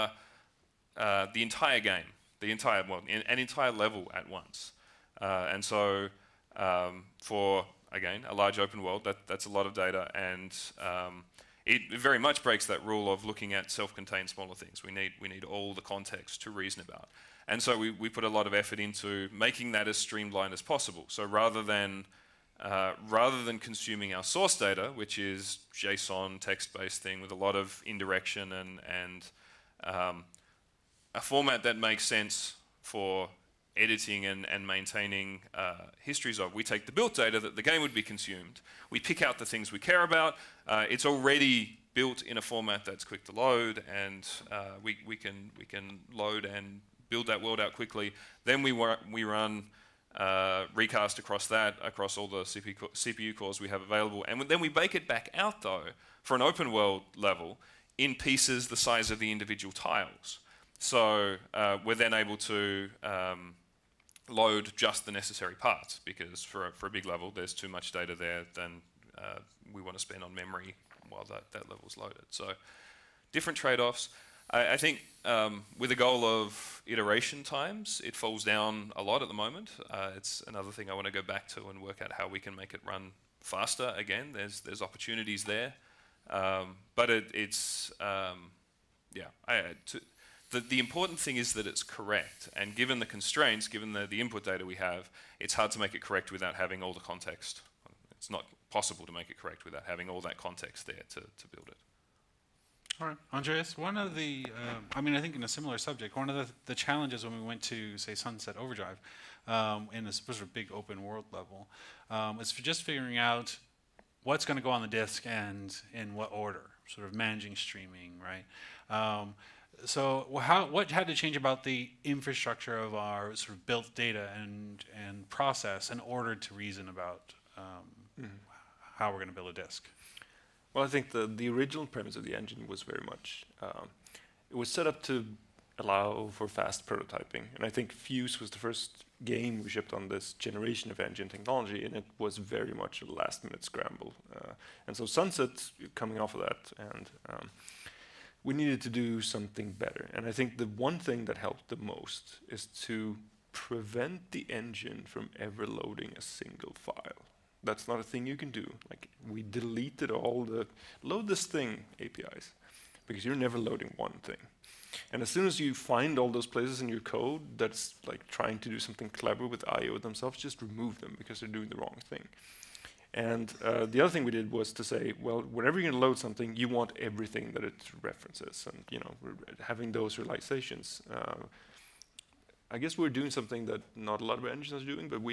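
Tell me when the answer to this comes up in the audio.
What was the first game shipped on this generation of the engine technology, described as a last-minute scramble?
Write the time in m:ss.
2:17.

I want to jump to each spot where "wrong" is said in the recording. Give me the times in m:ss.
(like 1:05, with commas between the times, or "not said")
2:51.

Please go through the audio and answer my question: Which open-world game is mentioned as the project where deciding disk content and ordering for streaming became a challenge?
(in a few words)
Sunset Overdrive.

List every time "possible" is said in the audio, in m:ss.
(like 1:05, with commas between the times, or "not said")
0:20, 1:38.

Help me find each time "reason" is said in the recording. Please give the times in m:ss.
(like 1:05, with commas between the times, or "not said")
0:16, 2:06.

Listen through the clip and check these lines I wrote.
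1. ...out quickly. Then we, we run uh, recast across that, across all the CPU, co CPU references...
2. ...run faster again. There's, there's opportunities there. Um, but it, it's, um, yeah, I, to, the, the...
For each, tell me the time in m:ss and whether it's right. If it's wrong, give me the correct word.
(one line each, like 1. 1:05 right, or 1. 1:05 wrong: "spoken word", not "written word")
1. 0:47 wrong: "cores", not "references"
2. 1:22 right.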